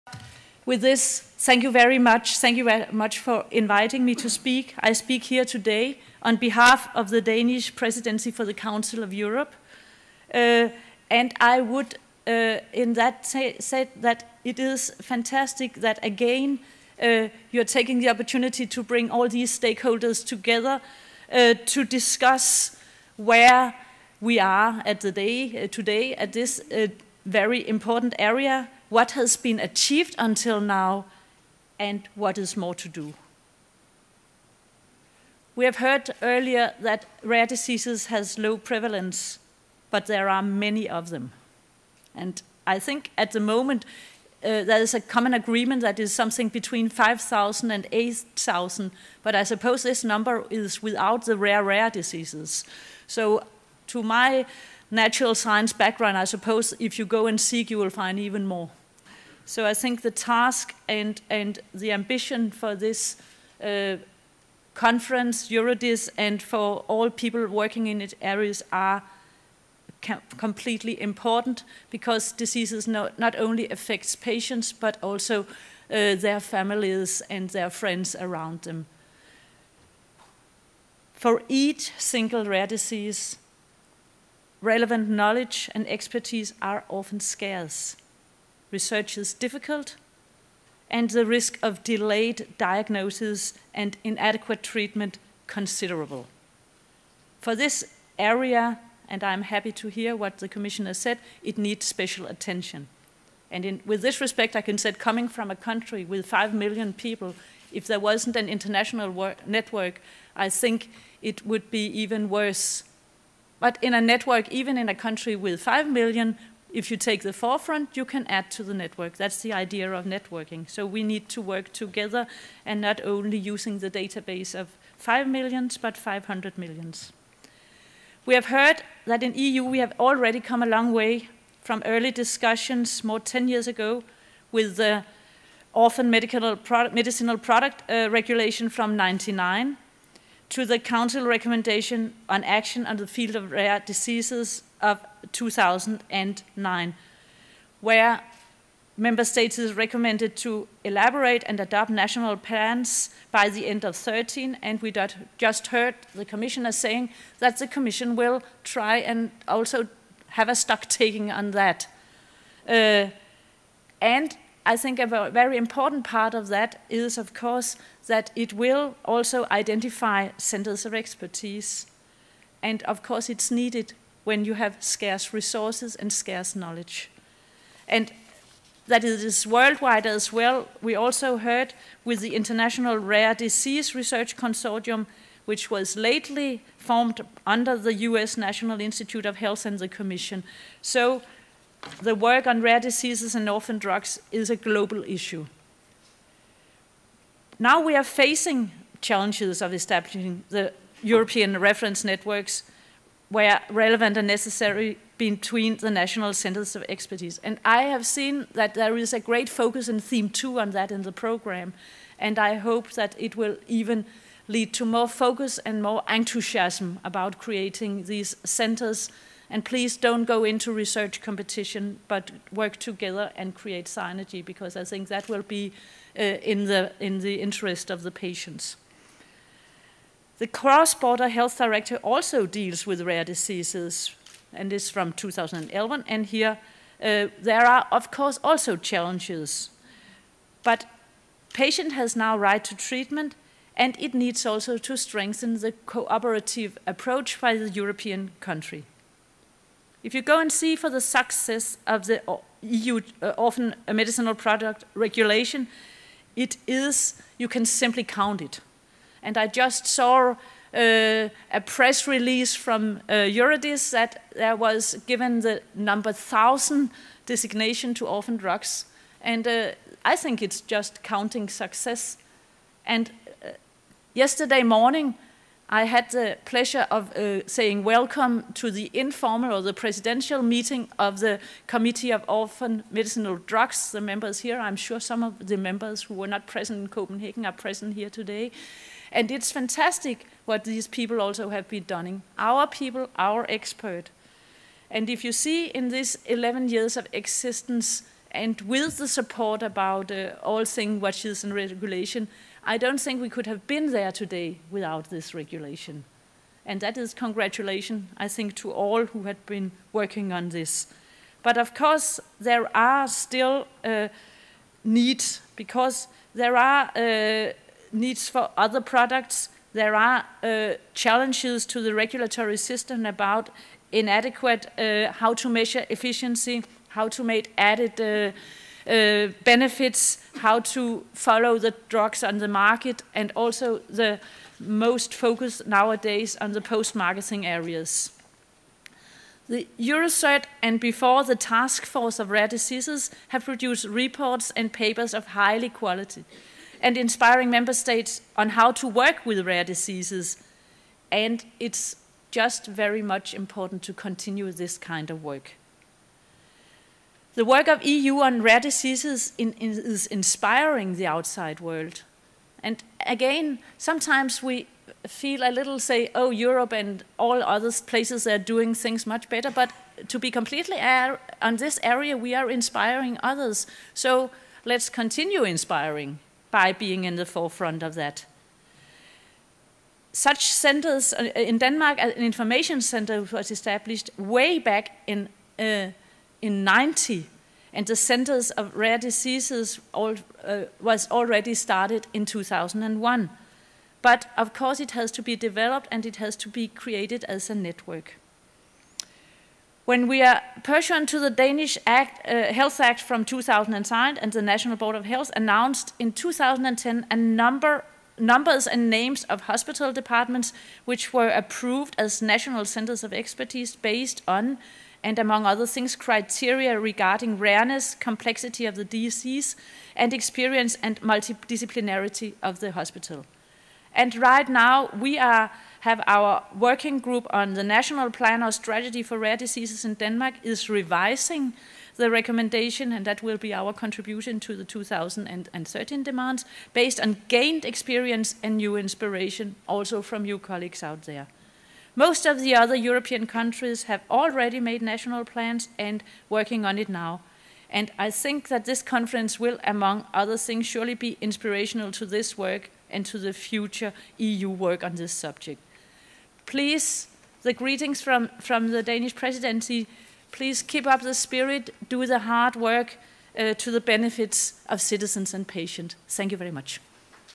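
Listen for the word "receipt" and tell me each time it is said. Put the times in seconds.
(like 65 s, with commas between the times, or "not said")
not said.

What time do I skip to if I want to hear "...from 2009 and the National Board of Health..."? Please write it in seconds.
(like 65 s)
403 s.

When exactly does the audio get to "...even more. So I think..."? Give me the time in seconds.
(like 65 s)
58 s.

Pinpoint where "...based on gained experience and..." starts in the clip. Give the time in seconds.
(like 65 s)
436 s.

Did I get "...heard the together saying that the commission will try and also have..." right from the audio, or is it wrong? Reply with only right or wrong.
wrong.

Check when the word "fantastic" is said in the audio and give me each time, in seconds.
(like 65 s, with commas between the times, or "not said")
15 s, 289 s.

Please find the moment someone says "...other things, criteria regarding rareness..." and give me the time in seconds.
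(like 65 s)
415 s.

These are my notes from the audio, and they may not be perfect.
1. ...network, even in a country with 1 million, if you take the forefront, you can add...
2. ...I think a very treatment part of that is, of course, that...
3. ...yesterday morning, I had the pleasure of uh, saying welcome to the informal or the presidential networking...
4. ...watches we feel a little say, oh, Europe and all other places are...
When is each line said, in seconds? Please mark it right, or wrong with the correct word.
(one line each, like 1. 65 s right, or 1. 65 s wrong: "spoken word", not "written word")
1. 114 s wrong: "5", not "1"
2. 164 s wrong: "important", not "treatment"
3. 274 s wrong: "meeting", not "networking"
4. 363 s wrong: "sometimes", not "watches".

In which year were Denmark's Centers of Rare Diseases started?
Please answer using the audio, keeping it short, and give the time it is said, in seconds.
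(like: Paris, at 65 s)
2001, at 392 s.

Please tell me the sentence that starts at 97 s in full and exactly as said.
For this area, and I'm happy to hear what the Commissioner said, it needs special attention.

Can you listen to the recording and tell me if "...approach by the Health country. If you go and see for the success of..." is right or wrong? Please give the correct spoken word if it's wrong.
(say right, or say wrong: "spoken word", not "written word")
wrong: "European", not "Health".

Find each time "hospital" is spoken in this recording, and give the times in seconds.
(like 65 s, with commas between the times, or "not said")
409 s, 422 s.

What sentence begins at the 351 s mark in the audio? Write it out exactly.
And it's just very much important to continue this kind of work.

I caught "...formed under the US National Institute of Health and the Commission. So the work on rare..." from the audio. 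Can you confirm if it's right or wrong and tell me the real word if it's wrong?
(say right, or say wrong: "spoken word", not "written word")
right.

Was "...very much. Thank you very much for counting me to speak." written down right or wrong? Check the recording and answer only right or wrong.
wrong.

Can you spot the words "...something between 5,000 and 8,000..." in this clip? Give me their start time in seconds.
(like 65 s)
46 s.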